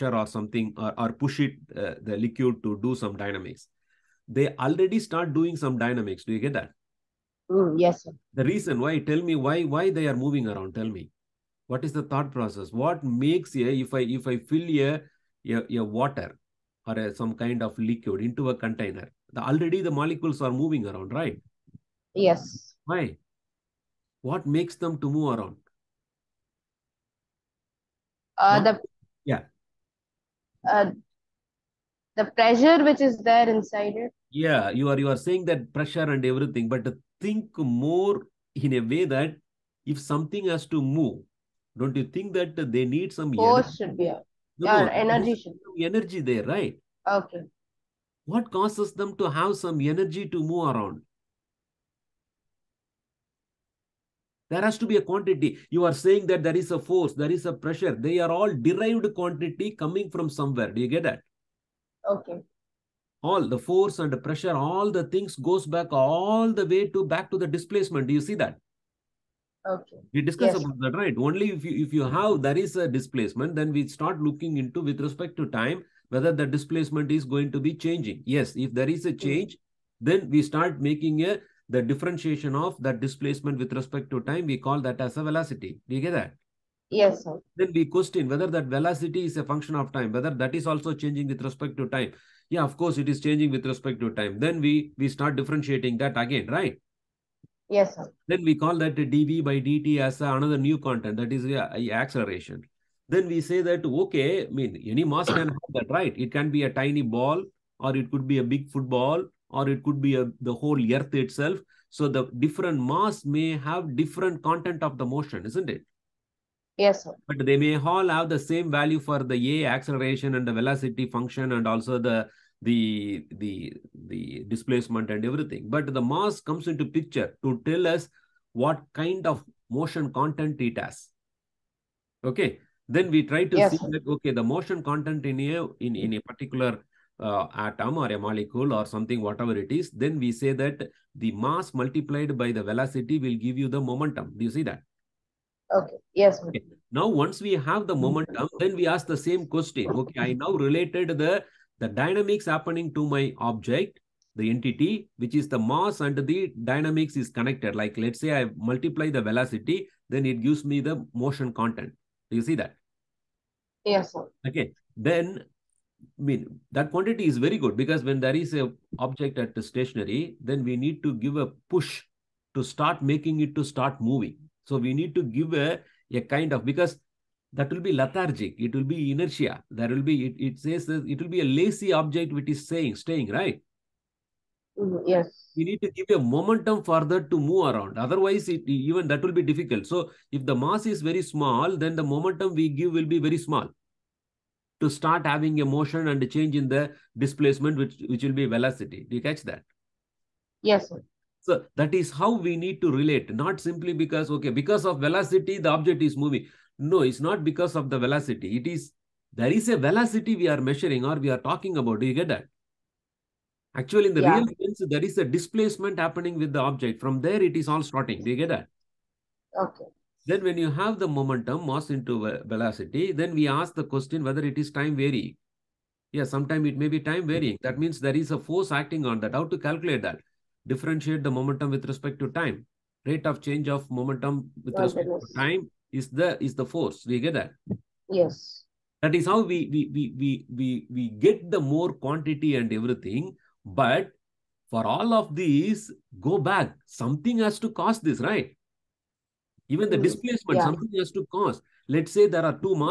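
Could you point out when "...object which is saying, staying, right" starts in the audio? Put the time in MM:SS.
03:01.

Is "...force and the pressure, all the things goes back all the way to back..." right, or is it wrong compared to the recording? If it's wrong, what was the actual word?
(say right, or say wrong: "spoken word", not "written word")
right.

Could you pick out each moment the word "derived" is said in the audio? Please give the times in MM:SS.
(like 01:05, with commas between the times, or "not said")
00:58.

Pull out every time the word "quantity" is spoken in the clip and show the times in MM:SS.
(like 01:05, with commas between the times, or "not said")
00:55, 00:59, 02:46, 04:01.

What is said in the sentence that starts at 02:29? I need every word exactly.
Okay, I now related the, the dynamics happening to my object, the entity, which is the mass and the dynamics is connected.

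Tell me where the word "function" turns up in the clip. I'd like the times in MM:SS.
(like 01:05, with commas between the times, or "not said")
01:29, 02:01.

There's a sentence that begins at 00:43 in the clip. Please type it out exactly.
should be No, yeah, no, energy should be.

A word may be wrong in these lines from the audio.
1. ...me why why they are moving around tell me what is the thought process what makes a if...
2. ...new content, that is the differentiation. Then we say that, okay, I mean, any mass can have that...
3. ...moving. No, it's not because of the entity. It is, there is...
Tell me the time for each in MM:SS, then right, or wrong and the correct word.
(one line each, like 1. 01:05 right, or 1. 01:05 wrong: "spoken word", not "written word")
1. 00:09 right
2. 01:40 wrong: "acceleration", not "differentiation"
3. 03:26 wrong: "velocity", not "entity".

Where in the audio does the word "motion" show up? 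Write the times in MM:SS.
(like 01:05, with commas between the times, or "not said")
01:55, 02:09, 02:14, 02:41, 03:15.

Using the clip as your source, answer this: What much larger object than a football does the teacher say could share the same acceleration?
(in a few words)
The whole earth.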